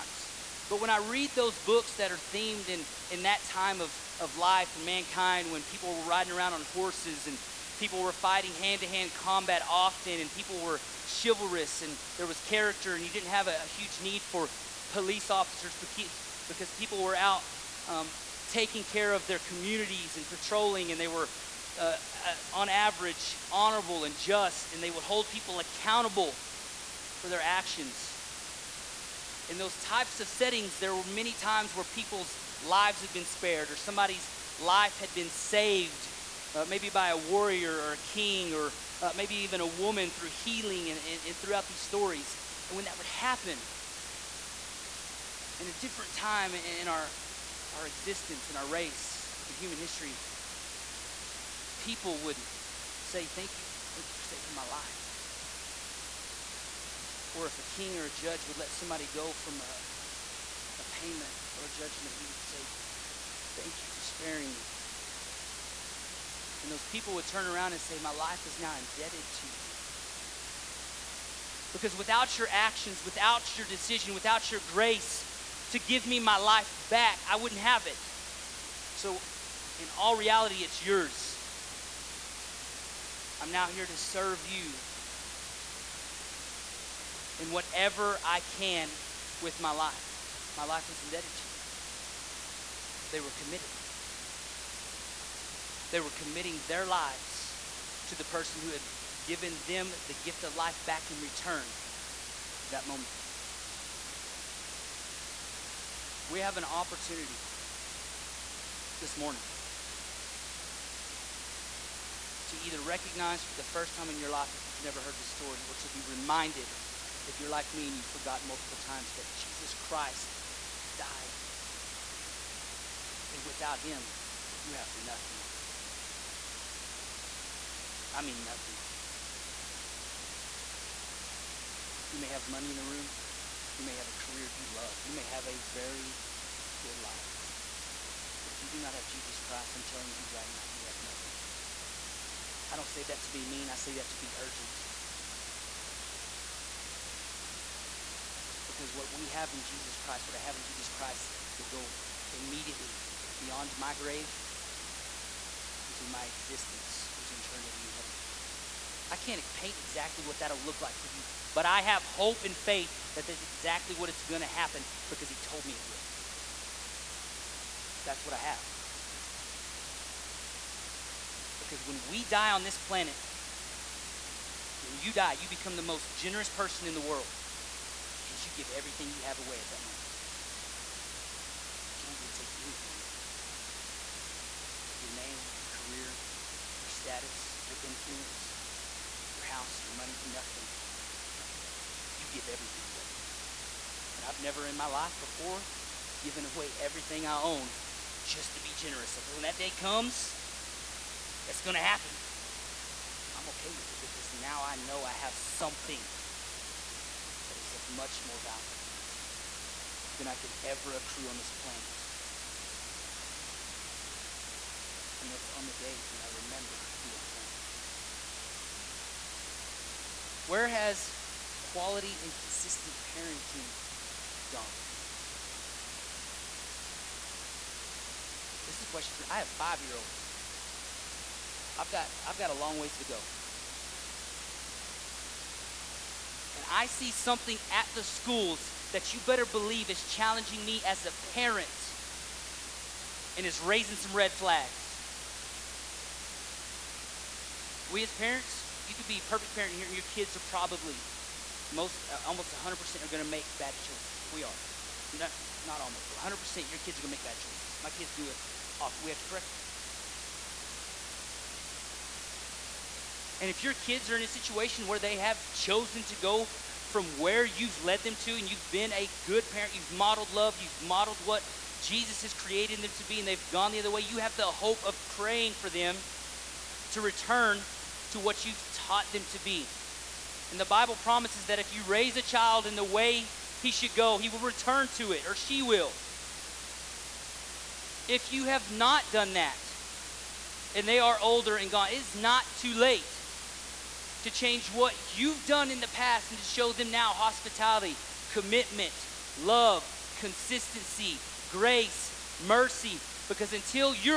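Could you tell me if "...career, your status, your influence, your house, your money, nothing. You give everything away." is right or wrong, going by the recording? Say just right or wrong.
right.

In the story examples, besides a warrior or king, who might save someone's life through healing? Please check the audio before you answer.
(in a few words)
A woman.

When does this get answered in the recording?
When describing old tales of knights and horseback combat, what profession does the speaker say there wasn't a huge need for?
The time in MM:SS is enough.
00:14.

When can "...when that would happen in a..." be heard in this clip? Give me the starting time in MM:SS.
00:42.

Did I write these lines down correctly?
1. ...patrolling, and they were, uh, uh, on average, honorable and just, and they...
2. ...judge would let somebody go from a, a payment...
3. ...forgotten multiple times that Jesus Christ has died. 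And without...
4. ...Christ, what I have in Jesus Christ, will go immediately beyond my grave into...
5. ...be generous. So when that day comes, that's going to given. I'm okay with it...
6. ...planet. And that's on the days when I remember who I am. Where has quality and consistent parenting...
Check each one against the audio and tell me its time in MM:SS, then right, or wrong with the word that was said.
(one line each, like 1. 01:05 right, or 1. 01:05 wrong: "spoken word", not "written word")
1. 00:20 right
2. 00:58 right
3. 01:58 right
4. 02:29 right
5. 03:18 wrong: "happen", not "given"
6. 03:31 right.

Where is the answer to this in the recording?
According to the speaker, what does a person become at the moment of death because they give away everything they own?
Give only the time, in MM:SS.
02:55.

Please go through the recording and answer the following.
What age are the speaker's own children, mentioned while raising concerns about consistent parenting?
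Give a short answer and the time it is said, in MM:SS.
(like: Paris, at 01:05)
5, at 03:49.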